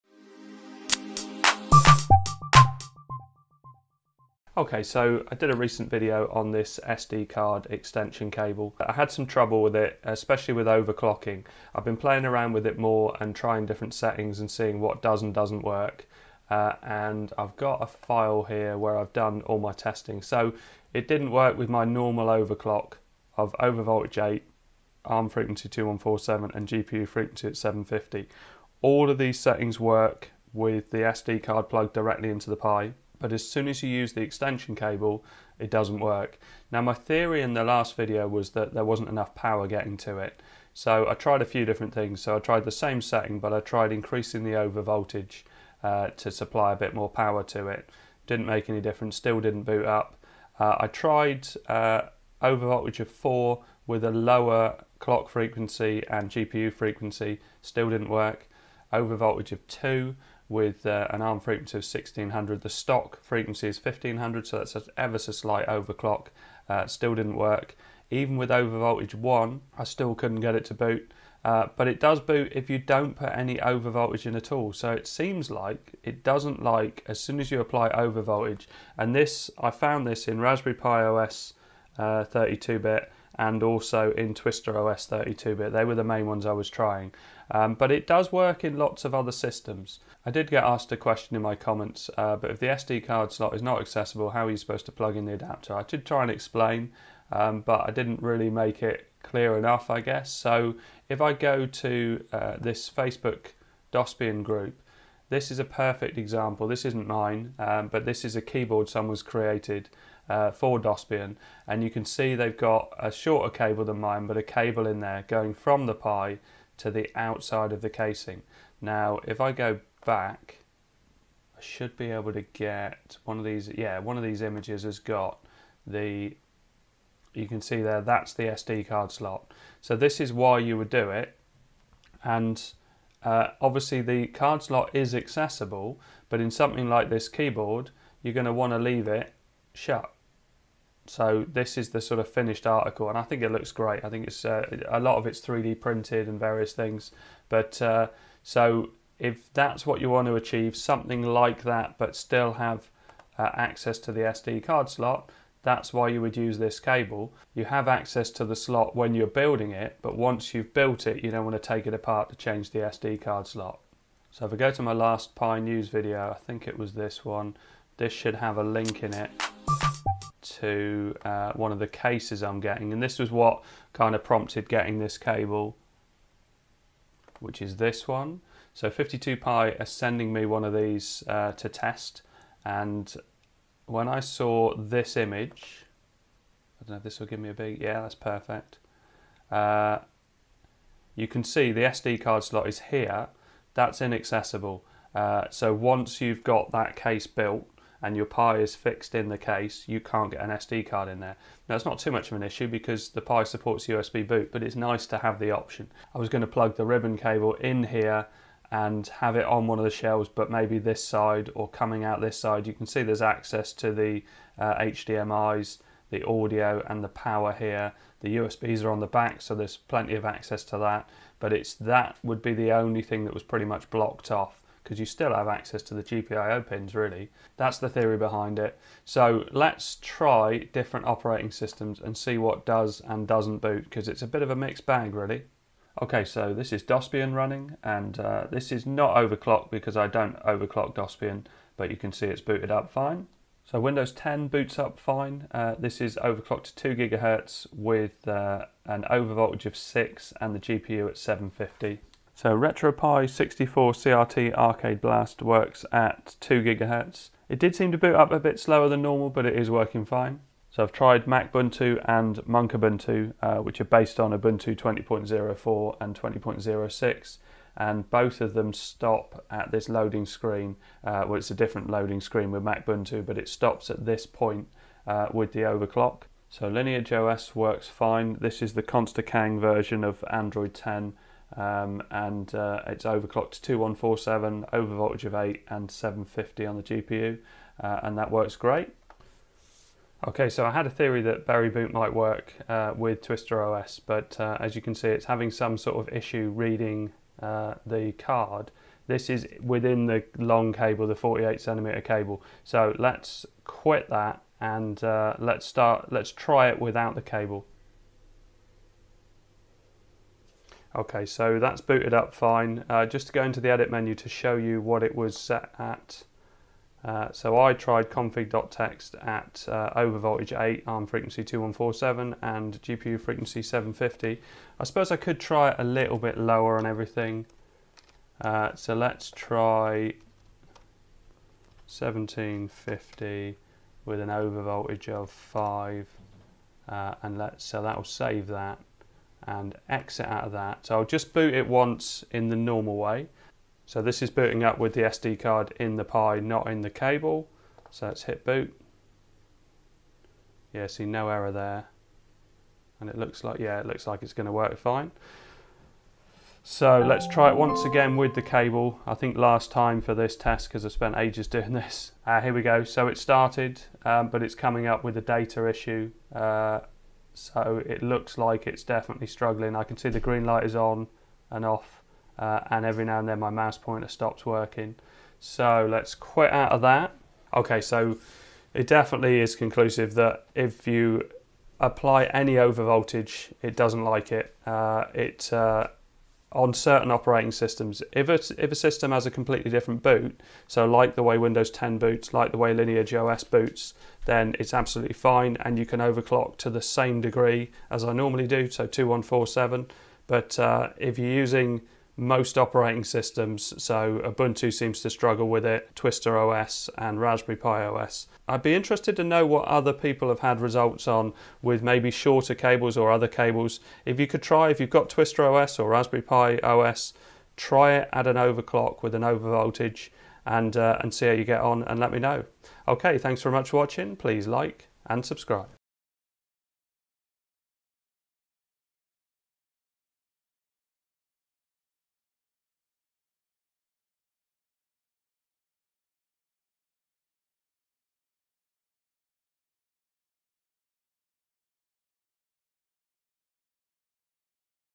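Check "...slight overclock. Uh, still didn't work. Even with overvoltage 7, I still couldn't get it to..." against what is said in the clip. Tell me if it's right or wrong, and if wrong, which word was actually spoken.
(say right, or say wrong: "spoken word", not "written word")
wrong: "1", not "7".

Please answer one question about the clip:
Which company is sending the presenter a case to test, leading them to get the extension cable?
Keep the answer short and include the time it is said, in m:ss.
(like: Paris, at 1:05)
52 Pi, at 2:58.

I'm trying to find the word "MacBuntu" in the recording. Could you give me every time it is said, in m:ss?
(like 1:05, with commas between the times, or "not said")
4:21, 4:32.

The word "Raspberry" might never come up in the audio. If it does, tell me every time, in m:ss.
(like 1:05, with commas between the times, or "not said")
1:20, 6:47, 6:55.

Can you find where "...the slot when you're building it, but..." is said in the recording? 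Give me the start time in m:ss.
2:38.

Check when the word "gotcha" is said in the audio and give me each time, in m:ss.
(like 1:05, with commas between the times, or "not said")
not said.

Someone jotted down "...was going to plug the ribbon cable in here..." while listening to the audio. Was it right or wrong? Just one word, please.
right.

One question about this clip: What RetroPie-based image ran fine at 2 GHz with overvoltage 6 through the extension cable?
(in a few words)
RetroPie 64 CRT Arcade Blast.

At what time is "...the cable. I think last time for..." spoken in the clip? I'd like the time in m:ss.
5:58.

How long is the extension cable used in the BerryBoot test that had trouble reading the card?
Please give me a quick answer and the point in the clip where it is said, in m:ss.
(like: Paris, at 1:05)
48 centimeters, at 5:01.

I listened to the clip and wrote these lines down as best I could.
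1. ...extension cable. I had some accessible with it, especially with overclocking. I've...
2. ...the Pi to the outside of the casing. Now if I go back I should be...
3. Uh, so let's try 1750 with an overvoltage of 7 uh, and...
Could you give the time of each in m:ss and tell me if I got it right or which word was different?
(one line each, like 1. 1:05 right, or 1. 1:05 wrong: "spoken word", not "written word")
1. 0:07 wrong: "trouble", not "accessible"
2. 1:55 right
3. 5:28 wrong: "5", not "7".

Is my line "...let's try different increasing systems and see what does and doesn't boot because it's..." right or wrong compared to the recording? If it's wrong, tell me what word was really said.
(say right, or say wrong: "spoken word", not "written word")
wrong: "operating", not "increasing".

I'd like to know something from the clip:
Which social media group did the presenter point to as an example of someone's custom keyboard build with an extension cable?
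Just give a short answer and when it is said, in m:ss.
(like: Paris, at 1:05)
Dosbian group, at 1:42.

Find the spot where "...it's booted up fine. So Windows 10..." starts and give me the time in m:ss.
4:02.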